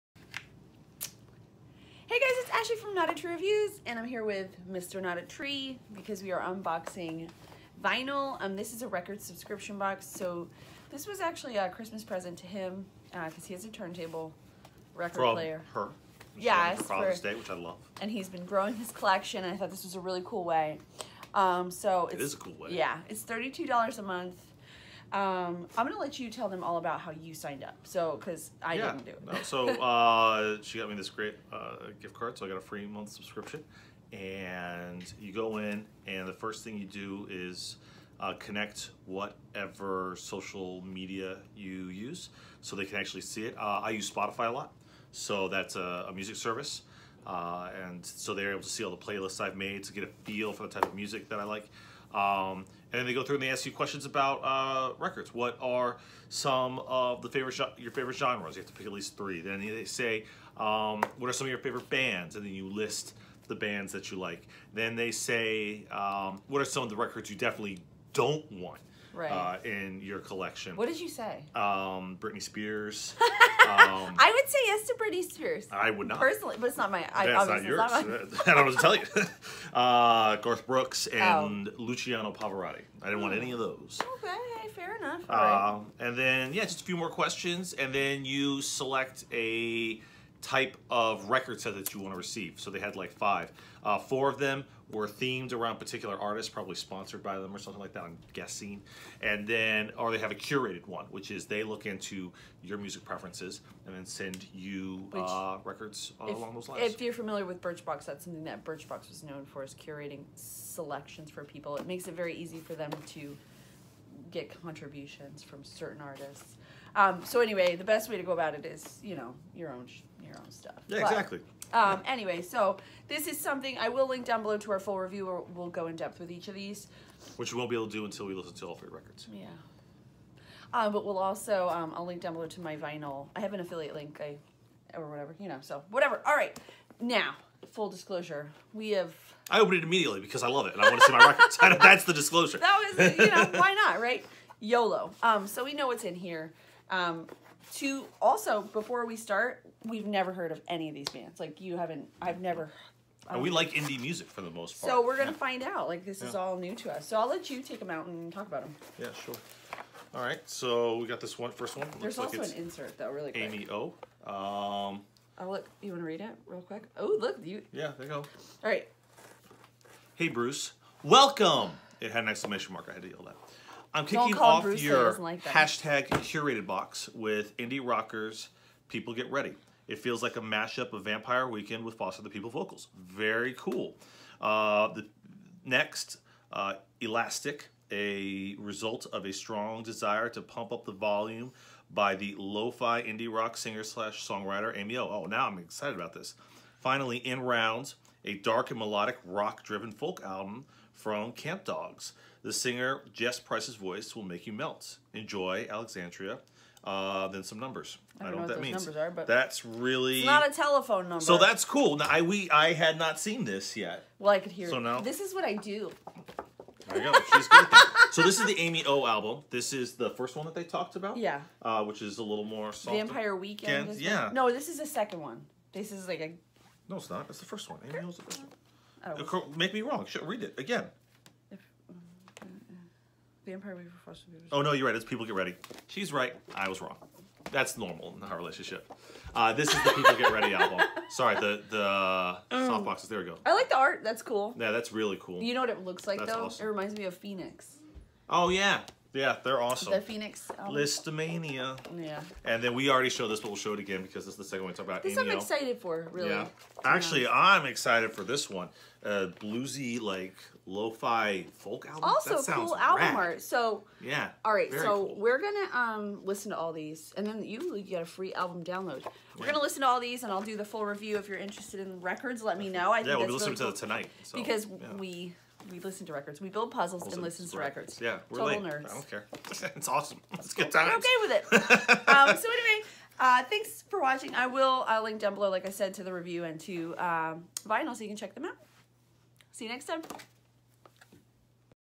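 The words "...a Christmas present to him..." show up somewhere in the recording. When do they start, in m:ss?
0:11.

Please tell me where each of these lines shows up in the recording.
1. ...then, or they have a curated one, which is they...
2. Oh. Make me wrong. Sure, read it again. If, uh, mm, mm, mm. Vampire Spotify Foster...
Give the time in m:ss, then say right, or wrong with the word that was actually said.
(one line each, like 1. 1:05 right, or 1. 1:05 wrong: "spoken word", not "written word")
1. 1:39 right
2. 3:49 wrong: "Weaver", not "Spotify".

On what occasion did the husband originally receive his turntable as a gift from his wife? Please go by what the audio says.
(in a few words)
Father's Day.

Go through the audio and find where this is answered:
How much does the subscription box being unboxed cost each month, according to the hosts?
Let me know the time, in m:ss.
0:23.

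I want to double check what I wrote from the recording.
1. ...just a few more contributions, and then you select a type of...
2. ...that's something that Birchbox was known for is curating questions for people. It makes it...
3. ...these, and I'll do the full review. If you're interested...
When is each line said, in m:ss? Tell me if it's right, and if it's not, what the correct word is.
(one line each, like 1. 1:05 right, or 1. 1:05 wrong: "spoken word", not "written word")
1. 1:26 wrong: "questions", not "contributions"
2. 1:48 wrong: "selections", not "questions"
3. 4:29 right.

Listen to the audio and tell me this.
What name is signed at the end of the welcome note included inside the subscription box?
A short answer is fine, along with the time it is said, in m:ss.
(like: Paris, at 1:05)
Alexandria, at 3:25.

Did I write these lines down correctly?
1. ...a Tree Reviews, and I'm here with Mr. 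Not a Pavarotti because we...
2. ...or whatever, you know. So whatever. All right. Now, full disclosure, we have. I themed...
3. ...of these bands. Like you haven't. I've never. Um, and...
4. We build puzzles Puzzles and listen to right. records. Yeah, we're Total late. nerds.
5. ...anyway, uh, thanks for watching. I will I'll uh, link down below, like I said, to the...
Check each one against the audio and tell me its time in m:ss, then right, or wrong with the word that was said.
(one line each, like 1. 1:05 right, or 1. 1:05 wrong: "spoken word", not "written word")
1. 0:03 wrong: "Tree", not "Pavarotti"
2. 2:14 wrong: "opened", not "themed"
3. 2:30 right
4. 4:36 right
5. 4:42 right.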